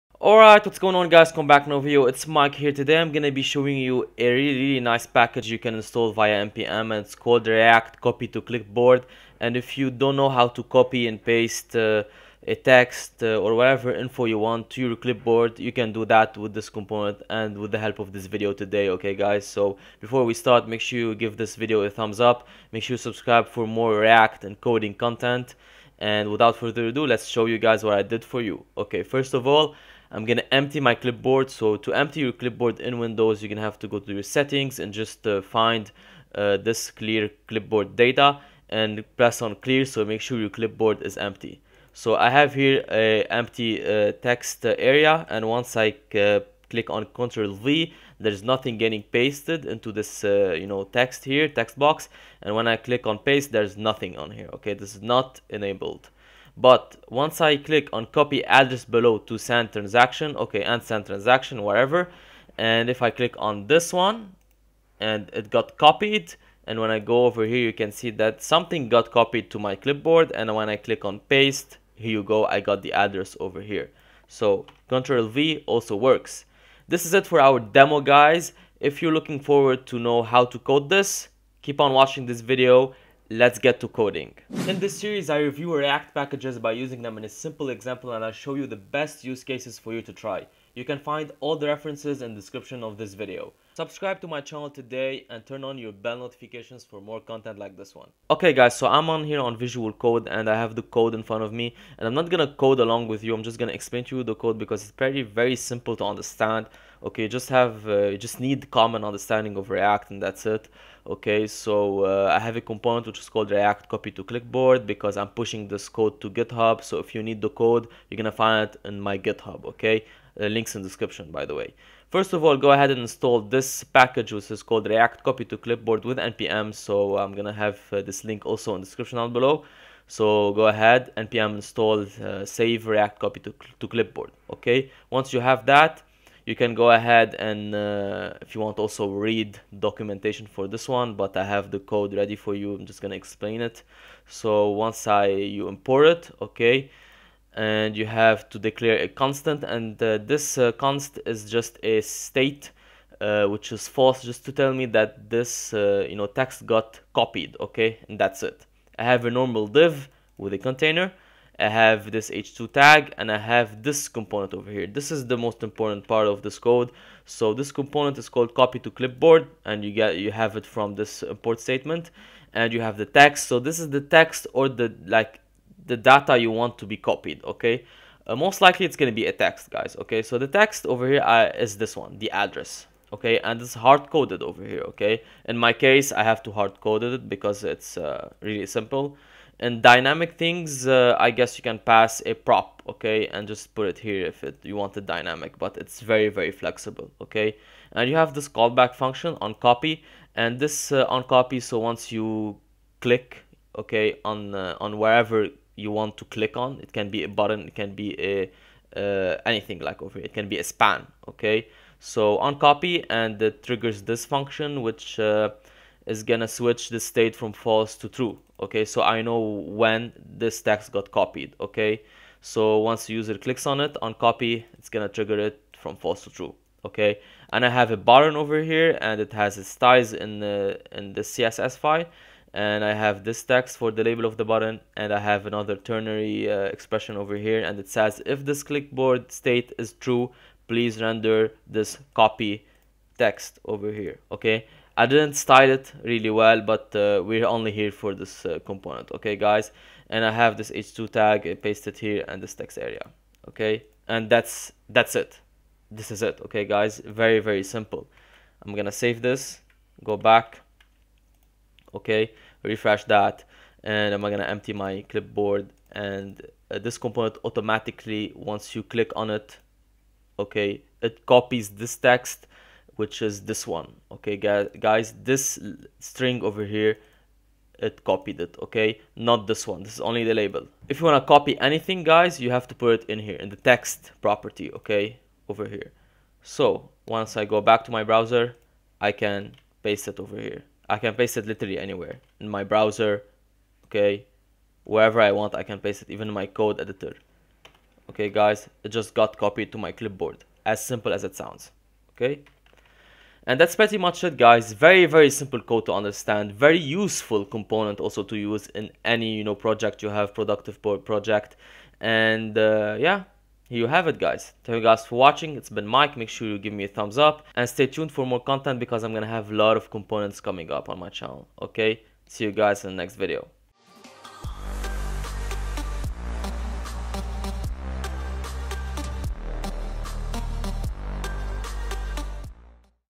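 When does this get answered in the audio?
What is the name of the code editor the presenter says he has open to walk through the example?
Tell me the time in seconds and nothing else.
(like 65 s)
99 s.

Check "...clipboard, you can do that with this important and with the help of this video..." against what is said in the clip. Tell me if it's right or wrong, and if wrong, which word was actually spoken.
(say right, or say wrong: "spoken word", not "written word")
wrong: "component", not "important".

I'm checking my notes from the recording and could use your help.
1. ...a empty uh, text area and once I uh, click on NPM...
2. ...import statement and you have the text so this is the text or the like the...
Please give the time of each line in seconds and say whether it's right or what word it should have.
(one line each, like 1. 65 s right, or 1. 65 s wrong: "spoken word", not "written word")
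1. 42 s wrong: "Ctrl", not "NPM"
2. 171 s right.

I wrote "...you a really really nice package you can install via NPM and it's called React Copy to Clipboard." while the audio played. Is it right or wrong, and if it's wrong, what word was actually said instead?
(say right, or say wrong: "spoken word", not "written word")
right.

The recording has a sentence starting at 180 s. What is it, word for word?
So the text over here uh, is this one, the address, okay?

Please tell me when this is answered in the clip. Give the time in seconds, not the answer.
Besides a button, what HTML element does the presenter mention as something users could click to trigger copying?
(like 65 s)
210 s.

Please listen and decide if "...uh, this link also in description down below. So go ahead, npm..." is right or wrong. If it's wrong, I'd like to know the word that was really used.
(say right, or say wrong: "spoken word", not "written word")
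right.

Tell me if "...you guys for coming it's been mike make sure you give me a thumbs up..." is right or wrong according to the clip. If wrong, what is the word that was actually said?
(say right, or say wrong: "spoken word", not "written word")
wrong: "watching", not "coming".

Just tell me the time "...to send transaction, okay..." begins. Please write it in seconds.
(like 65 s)
59 s.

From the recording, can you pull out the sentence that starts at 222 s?
So once the user clicks on it, on copy, it's gonna trigger it from false to true, okay?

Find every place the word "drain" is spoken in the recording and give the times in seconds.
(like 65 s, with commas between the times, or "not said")
not said.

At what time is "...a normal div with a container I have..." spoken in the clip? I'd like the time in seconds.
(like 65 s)
159 s.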